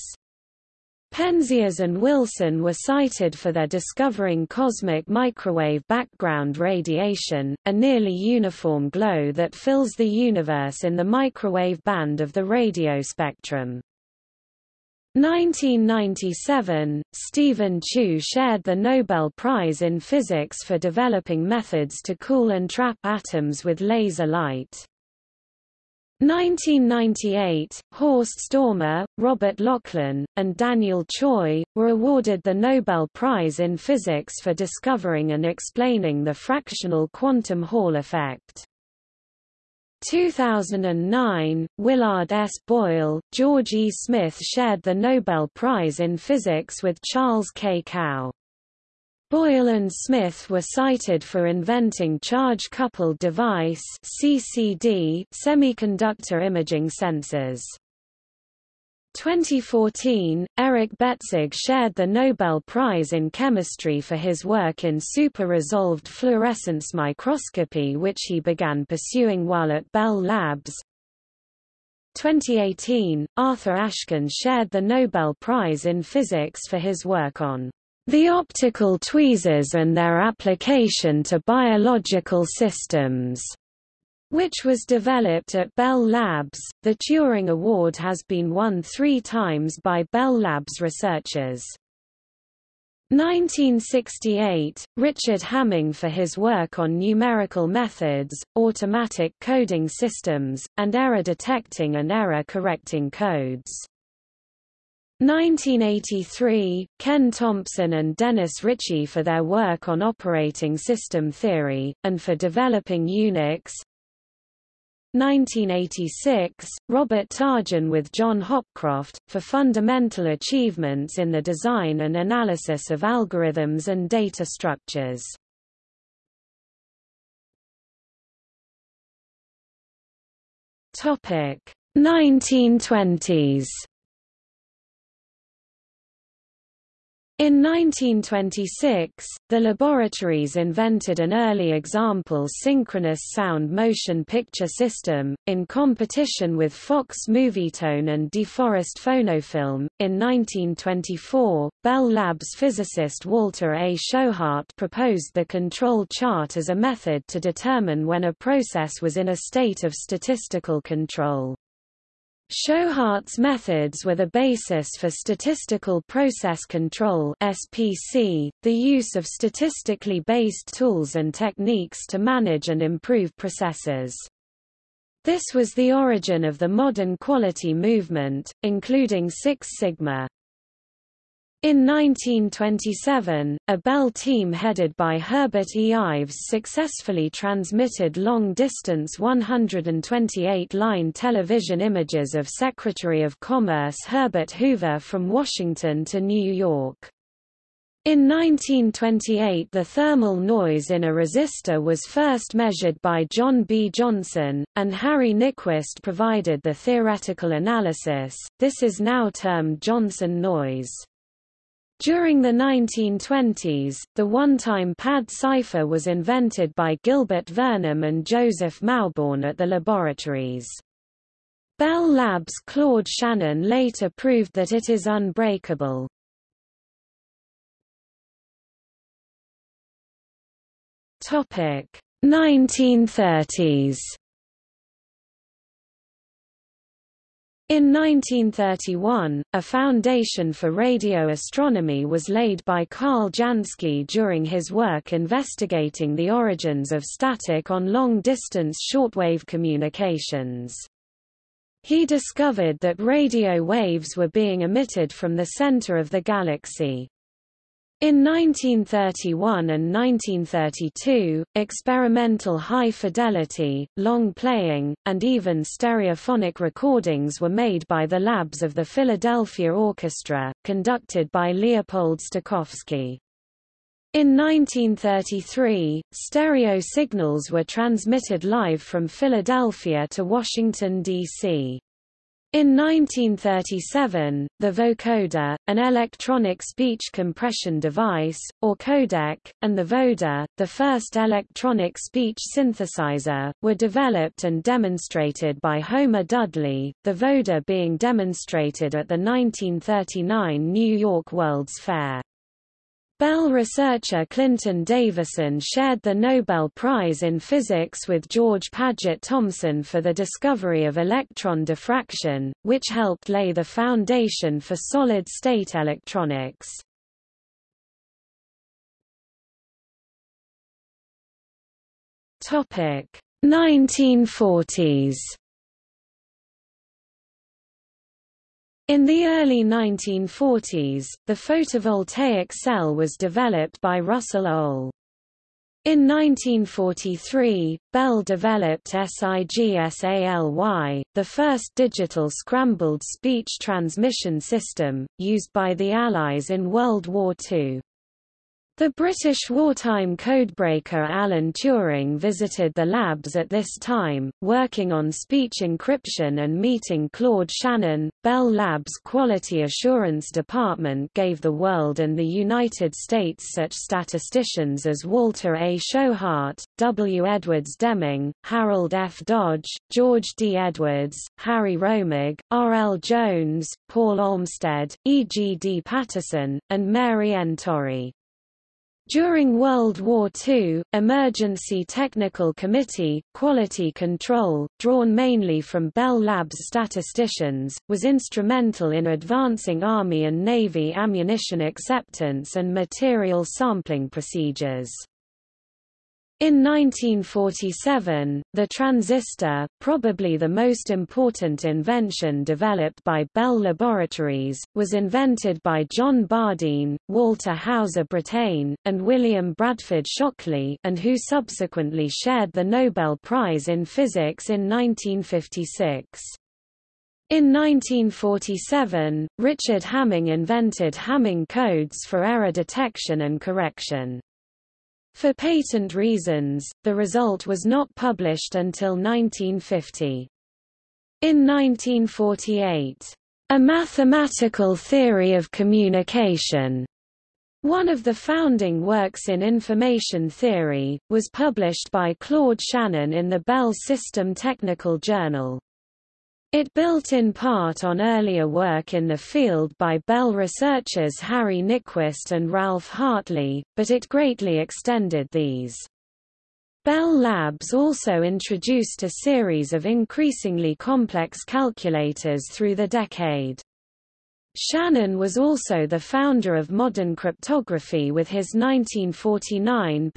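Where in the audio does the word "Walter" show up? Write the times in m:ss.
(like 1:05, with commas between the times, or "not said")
2:33, 6:05, 6:47.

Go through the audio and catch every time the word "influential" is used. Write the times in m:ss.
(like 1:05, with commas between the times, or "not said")
not said.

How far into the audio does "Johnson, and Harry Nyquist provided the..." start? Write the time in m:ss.
3:23.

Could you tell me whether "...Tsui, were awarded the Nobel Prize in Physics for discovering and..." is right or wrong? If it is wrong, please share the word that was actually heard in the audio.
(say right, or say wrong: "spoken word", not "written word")
right.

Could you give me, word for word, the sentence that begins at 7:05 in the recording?
For patent reasons, the result was not published until 1950.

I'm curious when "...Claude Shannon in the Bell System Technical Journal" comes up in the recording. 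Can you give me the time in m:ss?
7:22.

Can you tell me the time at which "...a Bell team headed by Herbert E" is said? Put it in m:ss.
3:03.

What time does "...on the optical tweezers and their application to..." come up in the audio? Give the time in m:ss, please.
1:17.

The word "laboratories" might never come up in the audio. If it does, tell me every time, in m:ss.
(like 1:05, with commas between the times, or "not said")
2:19, 3:39, 6:43.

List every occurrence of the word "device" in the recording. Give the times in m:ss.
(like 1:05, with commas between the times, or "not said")
0:53, 4:47.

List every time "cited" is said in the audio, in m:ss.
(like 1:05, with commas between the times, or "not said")
0:02, 0:50.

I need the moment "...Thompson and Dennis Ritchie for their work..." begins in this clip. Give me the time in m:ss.
1:47.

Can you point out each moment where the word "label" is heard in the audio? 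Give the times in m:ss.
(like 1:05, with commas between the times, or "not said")
not said.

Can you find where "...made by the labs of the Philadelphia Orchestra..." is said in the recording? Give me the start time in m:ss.
4:27.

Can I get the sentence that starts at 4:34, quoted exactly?
In 1933, stereo signals were transmitted live from Philadelphia to Washington, D.C.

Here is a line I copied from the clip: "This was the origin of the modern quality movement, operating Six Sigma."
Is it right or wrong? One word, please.
wrong.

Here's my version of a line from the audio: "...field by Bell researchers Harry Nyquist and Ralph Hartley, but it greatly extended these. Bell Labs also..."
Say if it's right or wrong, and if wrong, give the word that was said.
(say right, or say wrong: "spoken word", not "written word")
right.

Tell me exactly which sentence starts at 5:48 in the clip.
The British wartime codebreaker Alan Turing visited the labs at this time, working on speech encryption and meeting Claude Shannon.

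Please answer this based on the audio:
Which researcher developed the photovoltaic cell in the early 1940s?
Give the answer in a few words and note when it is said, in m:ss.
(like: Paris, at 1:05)
Russell Ohl, at 5:33.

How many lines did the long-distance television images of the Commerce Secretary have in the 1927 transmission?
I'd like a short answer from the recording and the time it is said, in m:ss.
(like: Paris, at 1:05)
128, at 3:09.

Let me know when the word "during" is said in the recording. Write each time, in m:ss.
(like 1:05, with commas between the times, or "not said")
3:31, 4:04, 6:19.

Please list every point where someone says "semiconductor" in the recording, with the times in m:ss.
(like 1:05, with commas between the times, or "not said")
0:55.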